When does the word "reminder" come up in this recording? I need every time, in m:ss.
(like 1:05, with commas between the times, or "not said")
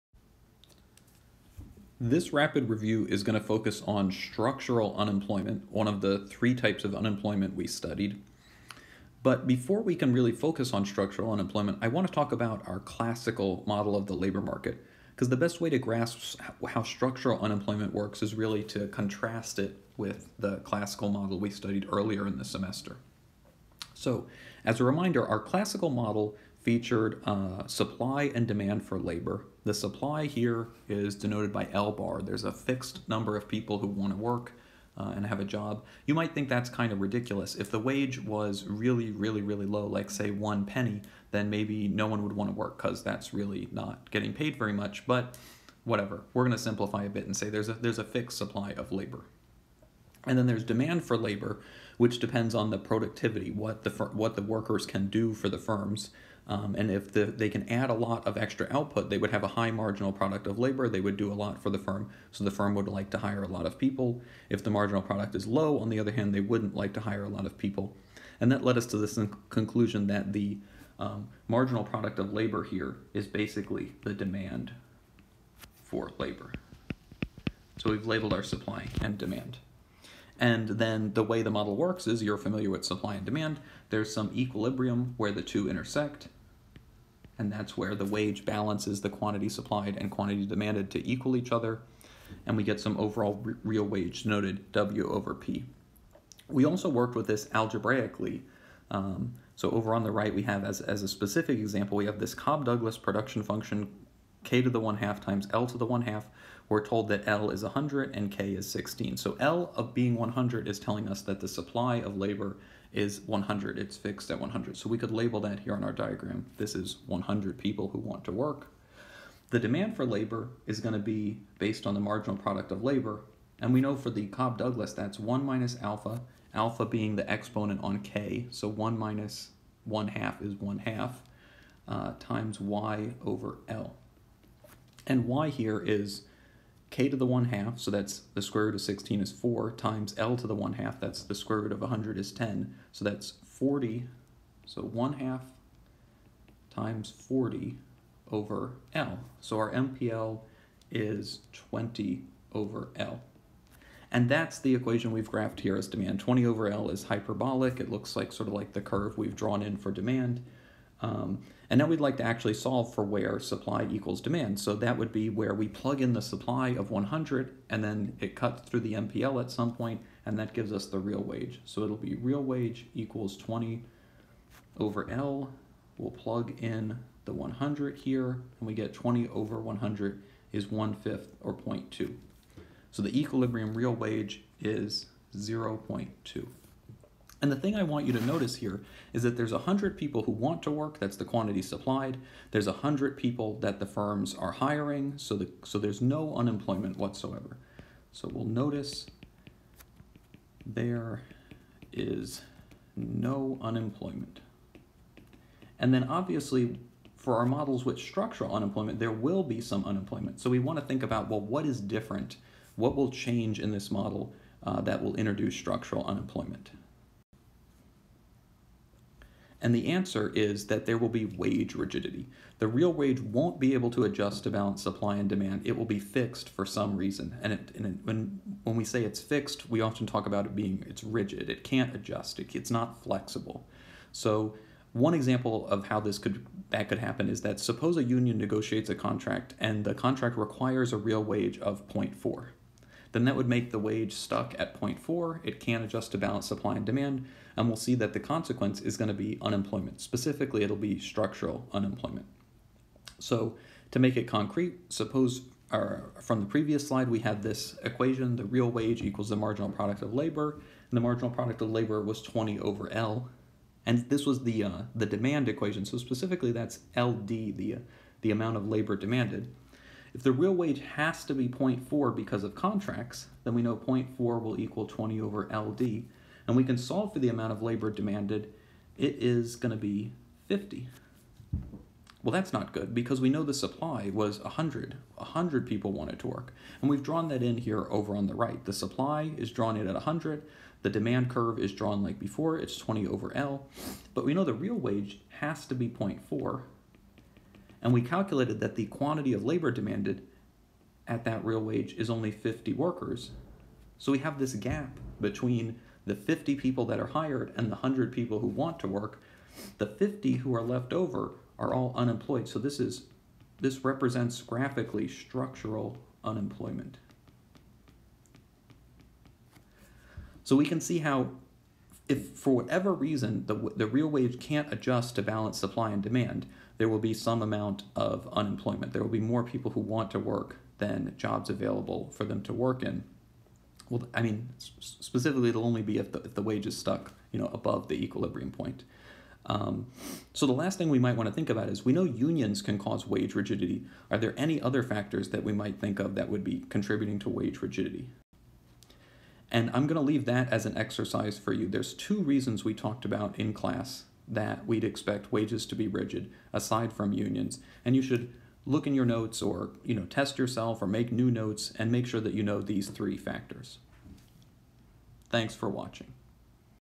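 0:24.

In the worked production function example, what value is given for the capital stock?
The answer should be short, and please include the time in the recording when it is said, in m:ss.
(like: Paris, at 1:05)
16, at 1:48.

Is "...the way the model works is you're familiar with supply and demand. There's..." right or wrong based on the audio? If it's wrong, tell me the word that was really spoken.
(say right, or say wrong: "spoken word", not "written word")
right.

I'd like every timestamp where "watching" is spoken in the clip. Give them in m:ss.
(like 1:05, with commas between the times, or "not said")
6:05.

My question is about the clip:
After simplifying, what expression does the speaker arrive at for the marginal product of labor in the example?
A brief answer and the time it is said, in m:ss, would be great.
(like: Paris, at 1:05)
20 over L, at 2:29.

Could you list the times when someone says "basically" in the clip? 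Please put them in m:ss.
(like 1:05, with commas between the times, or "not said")
1:13.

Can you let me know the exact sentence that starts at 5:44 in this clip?
Are there any other factors that we might think of that would be contributing to wage rigidity?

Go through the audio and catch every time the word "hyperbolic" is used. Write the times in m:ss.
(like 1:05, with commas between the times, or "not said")
2:37.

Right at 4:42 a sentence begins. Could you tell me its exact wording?
Well, that's not good because we know the supply was 100.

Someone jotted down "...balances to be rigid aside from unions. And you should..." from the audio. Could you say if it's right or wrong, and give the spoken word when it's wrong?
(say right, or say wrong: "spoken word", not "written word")
wrong: "wages", not "balances".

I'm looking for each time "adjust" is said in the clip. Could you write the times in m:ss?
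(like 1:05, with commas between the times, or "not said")
3:44, 3:51, 4:05, 5:24.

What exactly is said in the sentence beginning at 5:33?
Well, I mean, specifically, it'll only be if the, if the wage is stuck, you know, above the equilibrium point.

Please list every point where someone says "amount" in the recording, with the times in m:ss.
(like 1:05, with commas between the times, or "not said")
4:28, 4:37, 5:27.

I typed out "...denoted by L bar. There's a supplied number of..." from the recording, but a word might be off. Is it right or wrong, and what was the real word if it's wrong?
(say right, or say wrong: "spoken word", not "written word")
wrong: "fixed", not "supplied".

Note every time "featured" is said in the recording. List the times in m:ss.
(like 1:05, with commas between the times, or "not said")
0:26.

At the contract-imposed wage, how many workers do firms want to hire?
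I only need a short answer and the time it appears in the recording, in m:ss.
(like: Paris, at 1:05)
50, at 4:38.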